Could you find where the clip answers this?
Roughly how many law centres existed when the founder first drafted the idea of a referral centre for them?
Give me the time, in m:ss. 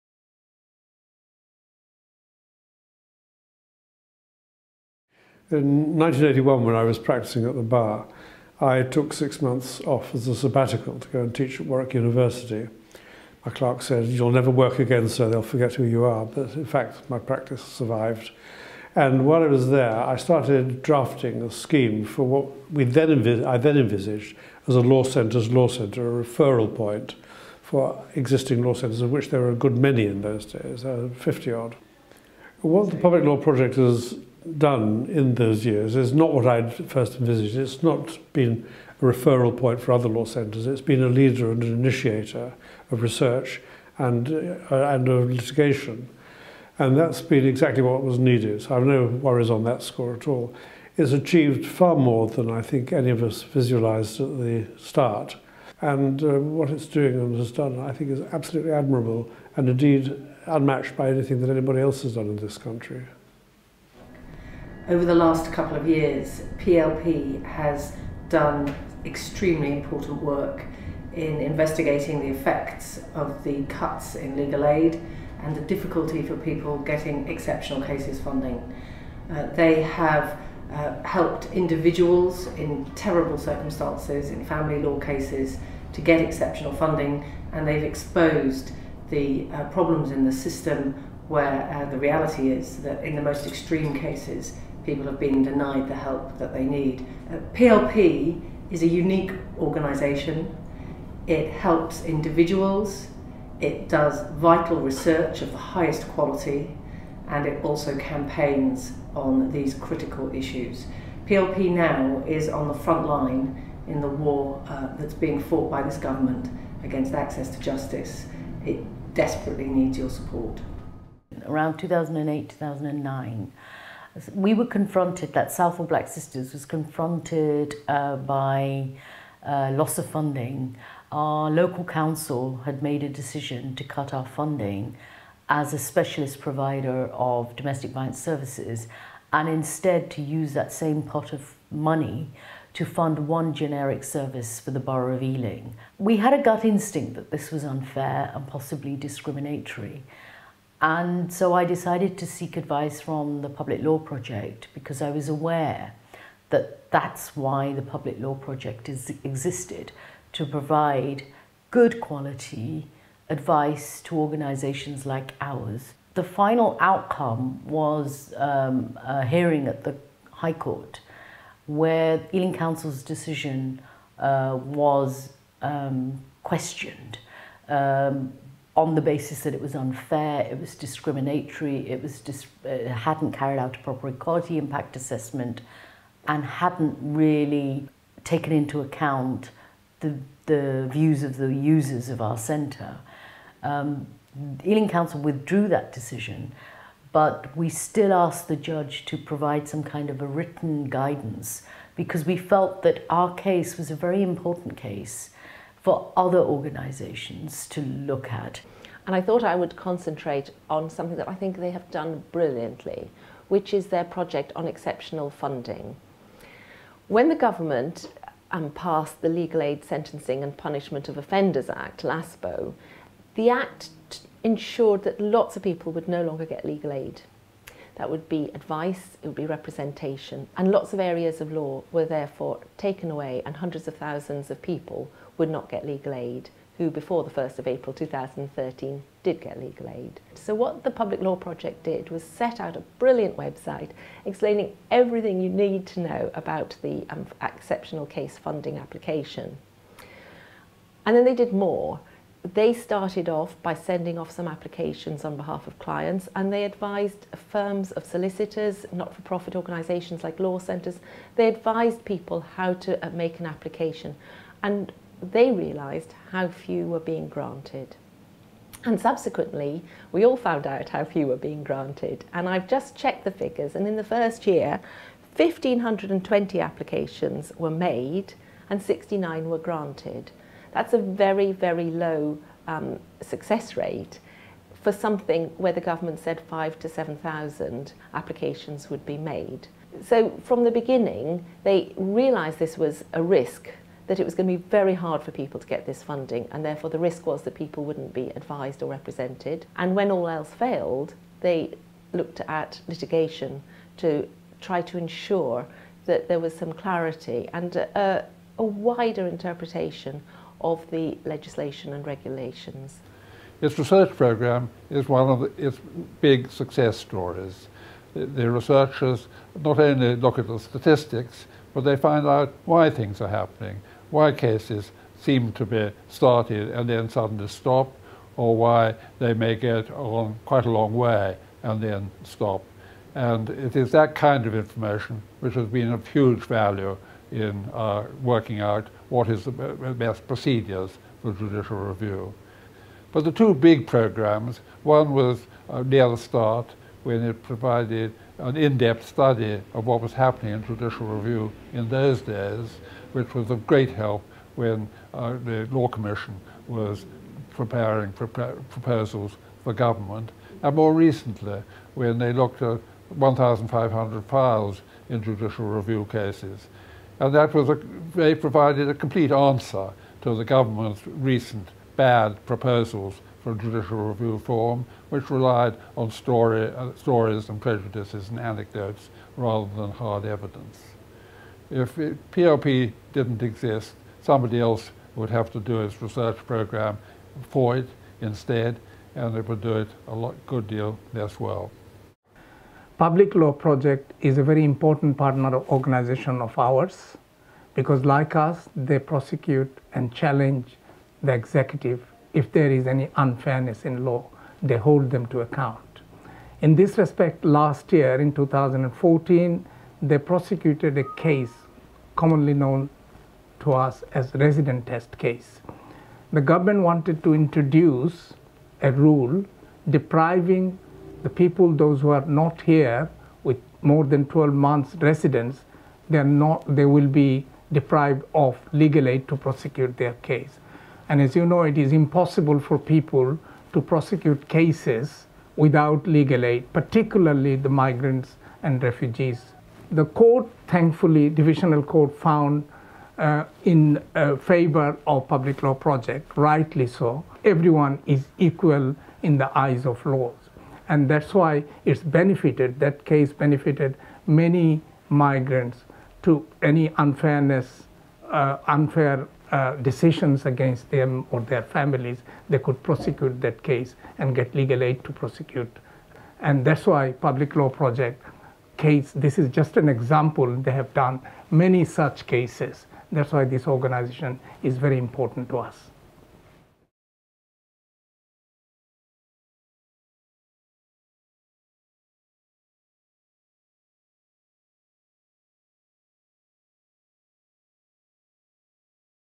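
0:31.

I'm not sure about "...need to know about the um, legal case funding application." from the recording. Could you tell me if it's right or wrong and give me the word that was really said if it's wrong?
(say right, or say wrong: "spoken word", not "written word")
wrong: "exceptional", not "legal".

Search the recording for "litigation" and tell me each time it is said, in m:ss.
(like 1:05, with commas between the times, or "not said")
0:45, 5:02.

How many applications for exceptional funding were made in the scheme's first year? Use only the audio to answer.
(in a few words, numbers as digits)
1,520.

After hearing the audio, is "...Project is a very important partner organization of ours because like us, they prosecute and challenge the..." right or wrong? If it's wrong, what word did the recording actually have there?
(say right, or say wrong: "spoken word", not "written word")
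right.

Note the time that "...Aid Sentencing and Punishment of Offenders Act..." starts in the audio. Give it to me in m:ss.
3:39.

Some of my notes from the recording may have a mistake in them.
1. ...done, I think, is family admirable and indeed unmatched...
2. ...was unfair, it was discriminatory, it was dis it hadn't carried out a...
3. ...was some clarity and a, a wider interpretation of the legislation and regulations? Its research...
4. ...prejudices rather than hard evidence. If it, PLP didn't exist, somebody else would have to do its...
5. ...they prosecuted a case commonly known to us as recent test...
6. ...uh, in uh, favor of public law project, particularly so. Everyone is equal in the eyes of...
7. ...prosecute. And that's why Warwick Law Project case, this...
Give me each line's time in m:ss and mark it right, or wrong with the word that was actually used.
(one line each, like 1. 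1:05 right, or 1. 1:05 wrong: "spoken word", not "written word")
1. 0:57 wrong: "absolutely", not "family"
2. 2:59 right
3. 5:06 right
4. 6:18 wrong: "anecdotes", not "prejudices"
5. 6:50 wrong: "resident", not "recent"
6. 7:23 wrong: "rightly", not "particularly"
7. 7:45 wrong: "Public", not "Warwick".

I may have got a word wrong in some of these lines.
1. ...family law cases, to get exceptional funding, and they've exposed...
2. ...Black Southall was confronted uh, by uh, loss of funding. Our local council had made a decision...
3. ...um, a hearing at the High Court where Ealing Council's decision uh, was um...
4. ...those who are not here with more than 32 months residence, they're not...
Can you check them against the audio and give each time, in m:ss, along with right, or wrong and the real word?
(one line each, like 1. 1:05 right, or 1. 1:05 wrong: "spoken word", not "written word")
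1. 1:24 right
2. 2:05 wrong: "Sisters", not "Southall"
3. 2:48 right
4. 7:01 wrong: "12", not "32".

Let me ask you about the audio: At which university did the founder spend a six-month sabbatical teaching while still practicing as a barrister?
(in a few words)
Warwick University.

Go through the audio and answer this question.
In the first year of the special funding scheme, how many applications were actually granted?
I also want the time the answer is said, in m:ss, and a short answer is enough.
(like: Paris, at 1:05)
69, at 4:38.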